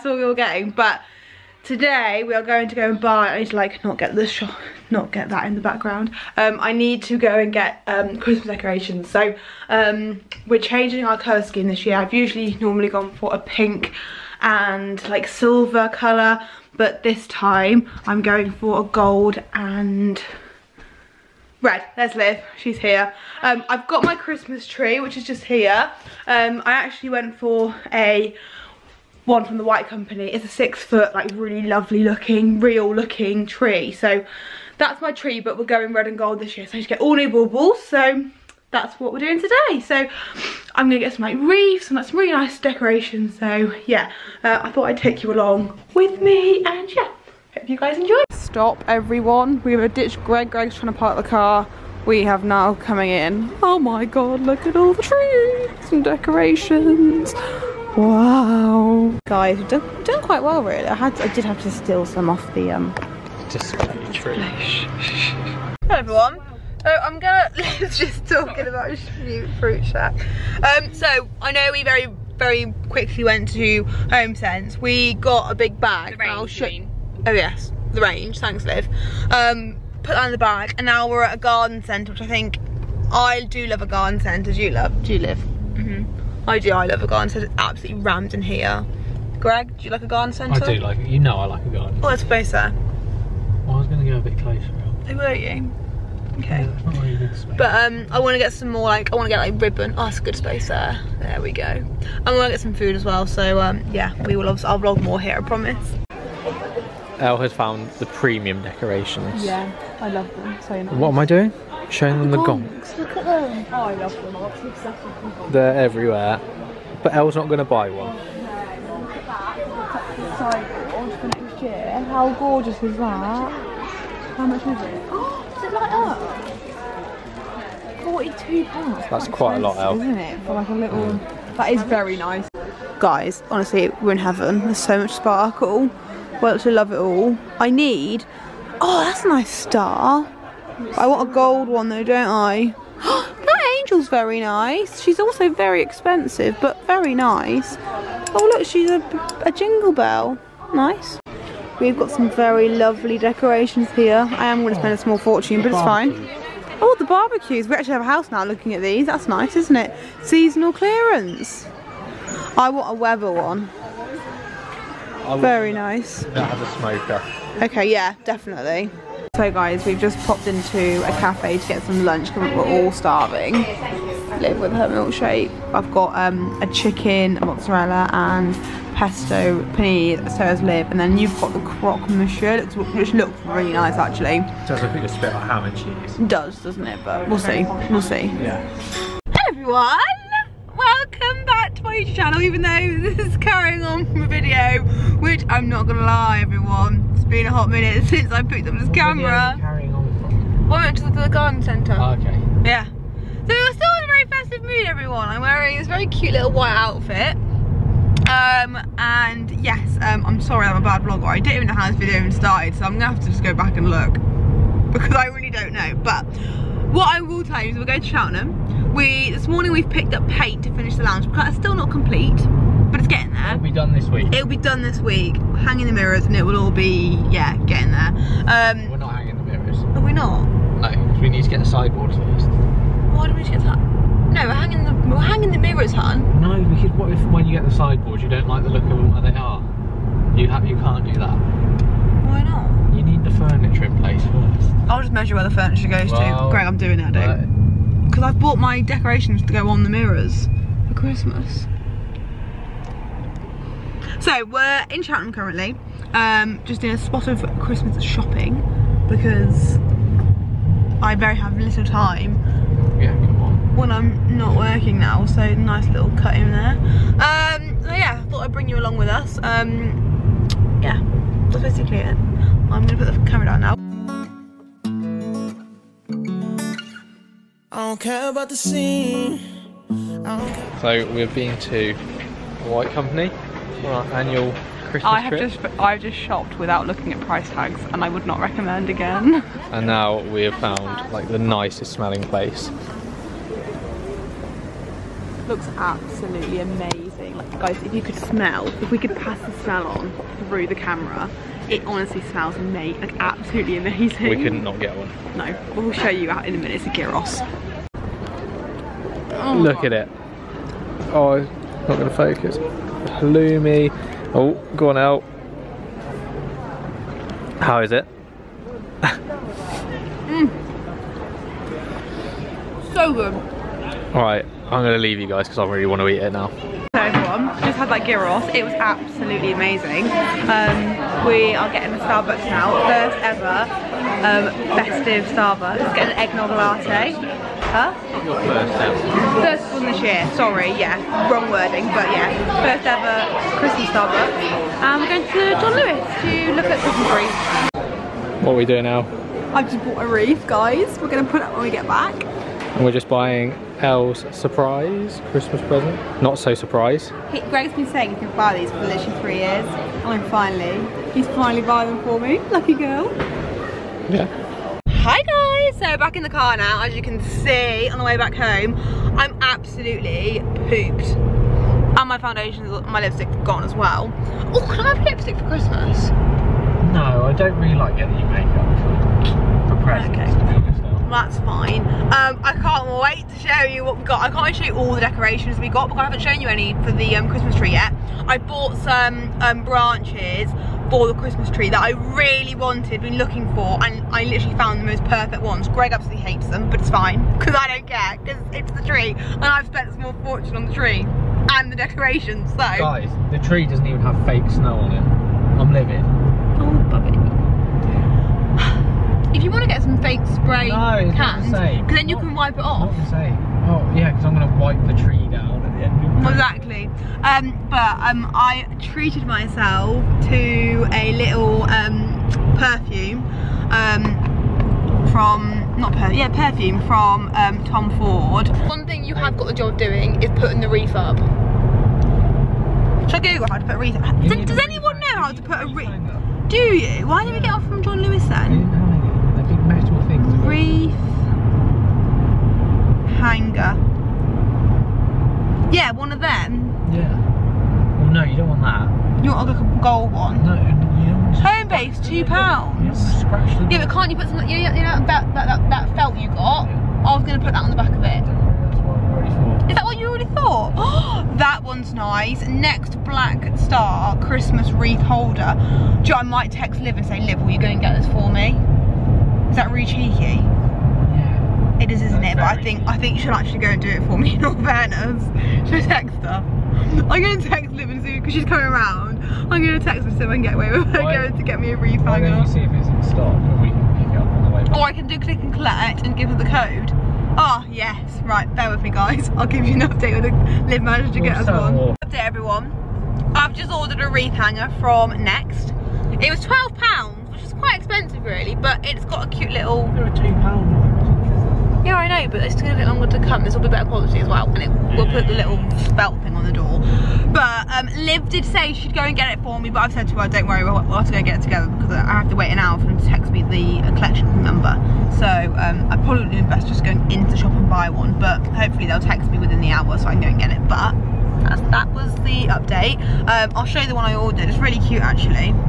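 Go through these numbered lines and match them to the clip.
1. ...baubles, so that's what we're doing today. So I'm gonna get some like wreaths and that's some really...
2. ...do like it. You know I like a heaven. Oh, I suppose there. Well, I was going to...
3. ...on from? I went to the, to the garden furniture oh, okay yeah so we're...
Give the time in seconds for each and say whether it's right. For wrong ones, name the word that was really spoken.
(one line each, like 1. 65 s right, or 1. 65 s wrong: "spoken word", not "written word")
1. 37 s right
2. 90 s wrong: "garden", not "heaven"
3. 199 s wrong: "centre", not "furniture".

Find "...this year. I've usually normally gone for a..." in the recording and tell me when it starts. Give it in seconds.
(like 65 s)
11 s.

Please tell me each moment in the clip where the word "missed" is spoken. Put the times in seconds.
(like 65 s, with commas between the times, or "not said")
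not said.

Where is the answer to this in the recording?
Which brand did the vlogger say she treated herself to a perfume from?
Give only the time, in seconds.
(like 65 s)
427 s.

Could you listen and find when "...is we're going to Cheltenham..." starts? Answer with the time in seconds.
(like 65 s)
217 s.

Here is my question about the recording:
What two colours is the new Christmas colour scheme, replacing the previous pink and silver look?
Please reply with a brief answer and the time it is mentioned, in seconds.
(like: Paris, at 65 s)
Gold and red, at 18 s.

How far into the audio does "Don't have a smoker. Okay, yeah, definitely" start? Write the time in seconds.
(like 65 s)
166 s.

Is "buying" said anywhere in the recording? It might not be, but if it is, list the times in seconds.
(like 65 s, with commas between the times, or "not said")
353 s, 361 s.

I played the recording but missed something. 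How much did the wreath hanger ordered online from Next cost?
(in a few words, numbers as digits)
£12.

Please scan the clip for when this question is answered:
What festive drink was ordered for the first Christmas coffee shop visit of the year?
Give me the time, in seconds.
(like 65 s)
336 s.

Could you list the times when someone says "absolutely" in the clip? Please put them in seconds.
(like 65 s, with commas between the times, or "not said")
87 s, 295 s, 303 s, 328 s, 369 s, 395 s.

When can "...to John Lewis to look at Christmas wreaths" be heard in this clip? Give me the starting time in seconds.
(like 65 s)
345 s.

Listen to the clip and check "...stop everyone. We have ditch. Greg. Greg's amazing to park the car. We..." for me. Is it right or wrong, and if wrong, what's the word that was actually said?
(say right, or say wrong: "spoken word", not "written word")
wrong: "trying", not "amazing".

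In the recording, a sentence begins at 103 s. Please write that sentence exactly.
So, um, yeah, we will, I'll vlog more here, I promise.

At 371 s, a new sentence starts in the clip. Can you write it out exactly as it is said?
And my foundation, my lipstick gone as well.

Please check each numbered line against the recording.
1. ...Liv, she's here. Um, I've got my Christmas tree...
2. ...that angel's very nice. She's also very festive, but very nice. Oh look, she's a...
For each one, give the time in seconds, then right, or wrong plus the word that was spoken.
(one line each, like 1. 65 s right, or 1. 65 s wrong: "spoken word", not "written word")
1. 22 s right
2. 142 s wrong: "expensive", not "festive".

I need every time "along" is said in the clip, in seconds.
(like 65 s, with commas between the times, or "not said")
45 s, 268 s.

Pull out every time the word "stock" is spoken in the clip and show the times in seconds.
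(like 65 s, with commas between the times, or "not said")
483 s.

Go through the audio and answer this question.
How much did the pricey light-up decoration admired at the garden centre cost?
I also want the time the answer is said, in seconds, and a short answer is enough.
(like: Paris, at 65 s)
£42, at 128 s.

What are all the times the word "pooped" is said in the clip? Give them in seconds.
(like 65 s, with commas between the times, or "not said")
370 s.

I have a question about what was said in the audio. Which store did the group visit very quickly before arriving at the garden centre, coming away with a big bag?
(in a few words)
HomeSense.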